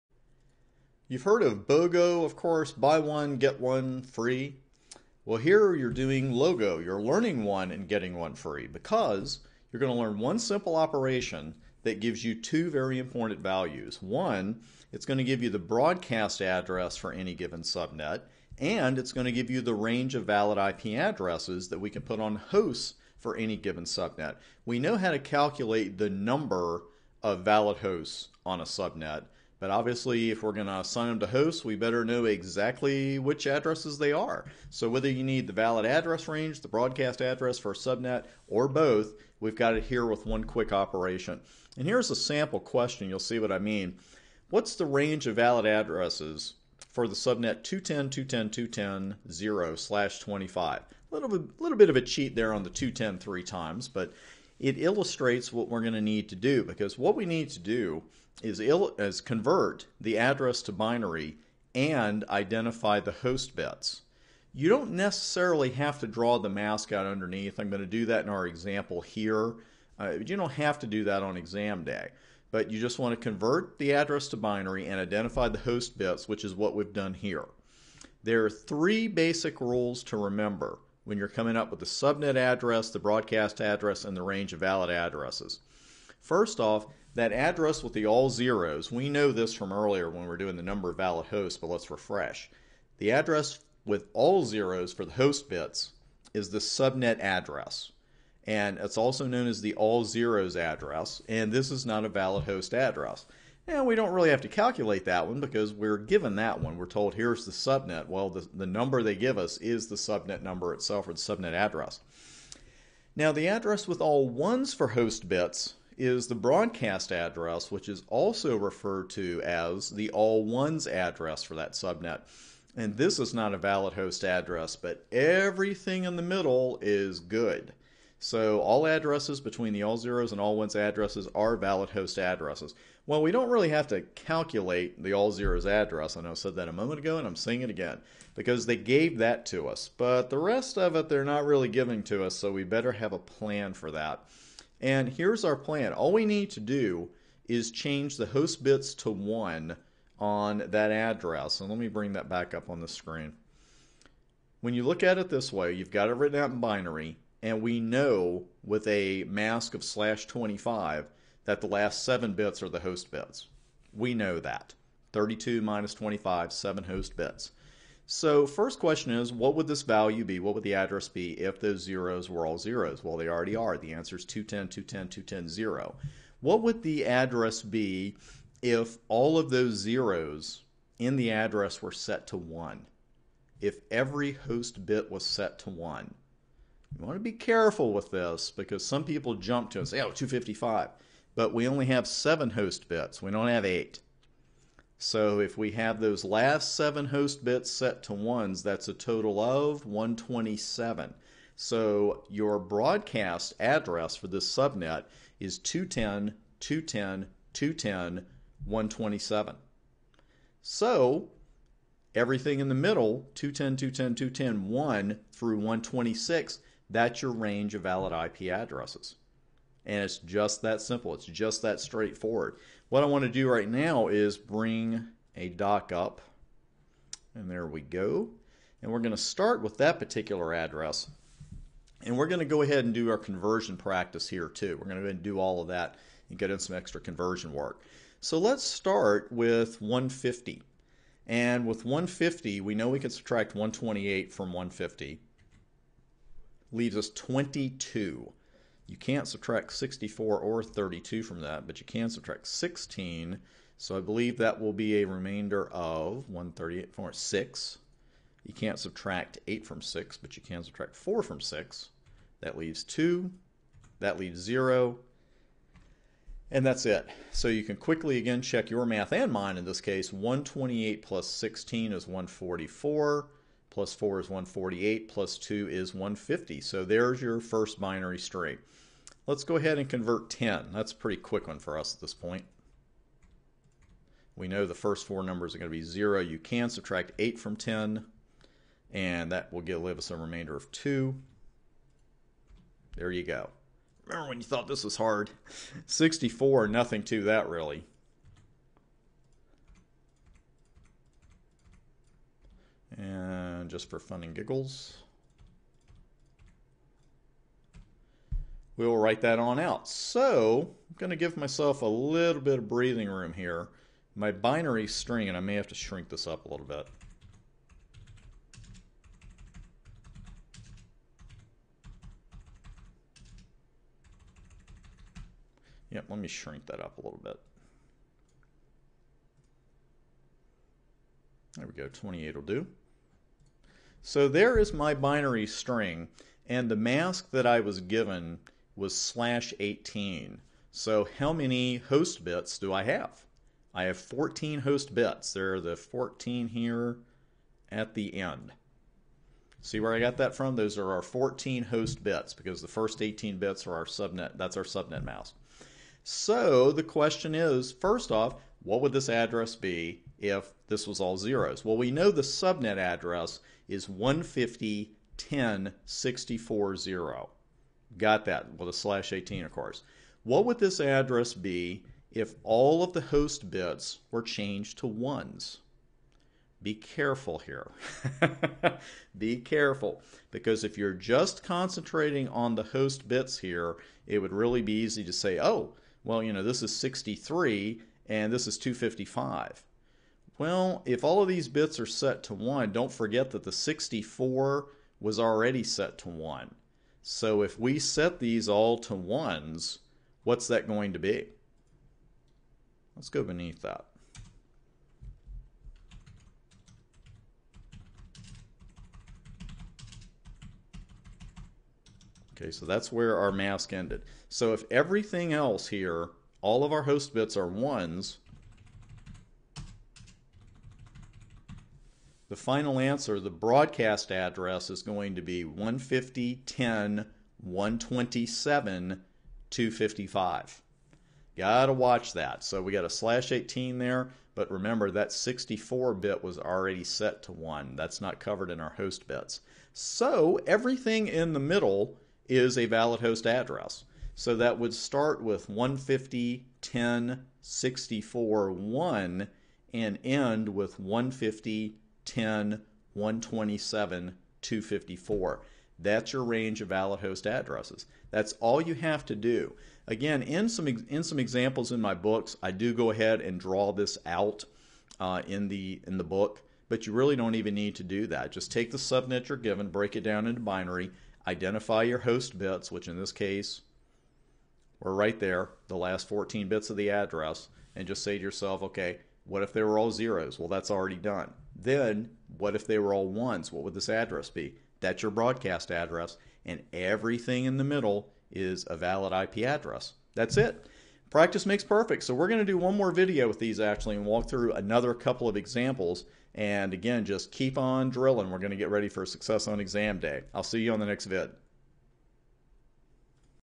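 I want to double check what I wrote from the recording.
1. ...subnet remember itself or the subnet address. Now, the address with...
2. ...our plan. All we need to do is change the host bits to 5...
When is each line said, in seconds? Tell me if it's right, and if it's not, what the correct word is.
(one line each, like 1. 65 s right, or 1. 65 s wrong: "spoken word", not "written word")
1. 109 s wrong: "number", not "remember"
2. 145 s wrong: "1", not "5".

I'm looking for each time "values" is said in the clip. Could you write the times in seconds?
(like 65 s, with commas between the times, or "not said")
13 s, 169 s.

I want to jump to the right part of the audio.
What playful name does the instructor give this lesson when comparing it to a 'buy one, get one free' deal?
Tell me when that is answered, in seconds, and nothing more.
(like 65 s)
6 s.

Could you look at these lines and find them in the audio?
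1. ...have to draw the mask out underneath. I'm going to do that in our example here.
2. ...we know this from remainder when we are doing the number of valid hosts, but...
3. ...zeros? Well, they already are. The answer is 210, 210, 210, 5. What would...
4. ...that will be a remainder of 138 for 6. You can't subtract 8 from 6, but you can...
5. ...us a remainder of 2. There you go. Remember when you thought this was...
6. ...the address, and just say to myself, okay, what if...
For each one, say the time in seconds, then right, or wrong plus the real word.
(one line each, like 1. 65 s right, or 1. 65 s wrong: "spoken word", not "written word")
1. 65 s right
2. 88 s wrong: "earlier", not "remainder"
3. 172 s wrong: "0", not "5"
4. 254 s right
5. 289 s right
6. 476 s wrong: "yourself", not "myself".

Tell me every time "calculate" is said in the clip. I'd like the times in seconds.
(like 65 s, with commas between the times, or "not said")
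25 s, 104 s, 134 s.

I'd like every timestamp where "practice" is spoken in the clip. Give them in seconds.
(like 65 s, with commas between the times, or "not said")
233 s, 491 s.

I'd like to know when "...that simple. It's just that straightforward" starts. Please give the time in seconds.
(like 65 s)
220 s.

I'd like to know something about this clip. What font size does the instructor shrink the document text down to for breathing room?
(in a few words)
28.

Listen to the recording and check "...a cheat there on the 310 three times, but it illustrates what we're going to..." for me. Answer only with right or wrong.
wrong.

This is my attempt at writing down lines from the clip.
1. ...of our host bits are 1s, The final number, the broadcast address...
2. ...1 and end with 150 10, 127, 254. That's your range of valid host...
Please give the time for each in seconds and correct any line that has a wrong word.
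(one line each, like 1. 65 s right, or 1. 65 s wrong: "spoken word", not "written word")
1. 416 s wrong: "answer", not "number"
2. 448 s right.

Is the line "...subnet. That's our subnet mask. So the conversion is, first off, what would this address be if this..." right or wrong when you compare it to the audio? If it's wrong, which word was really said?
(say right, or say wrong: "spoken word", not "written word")
wrong: "question", not "conversion".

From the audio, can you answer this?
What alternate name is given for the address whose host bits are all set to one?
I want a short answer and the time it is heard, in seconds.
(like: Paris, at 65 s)
all ones address, at 120 s.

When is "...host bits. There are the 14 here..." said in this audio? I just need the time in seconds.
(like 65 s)
344 s.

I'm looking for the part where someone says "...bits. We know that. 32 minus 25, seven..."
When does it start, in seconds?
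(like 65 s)
163 s.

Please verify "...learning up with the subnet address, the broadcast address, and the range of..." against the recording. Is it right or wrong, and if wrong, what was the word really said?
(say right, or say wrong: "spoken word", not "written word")
wrong: "coming", not "learning".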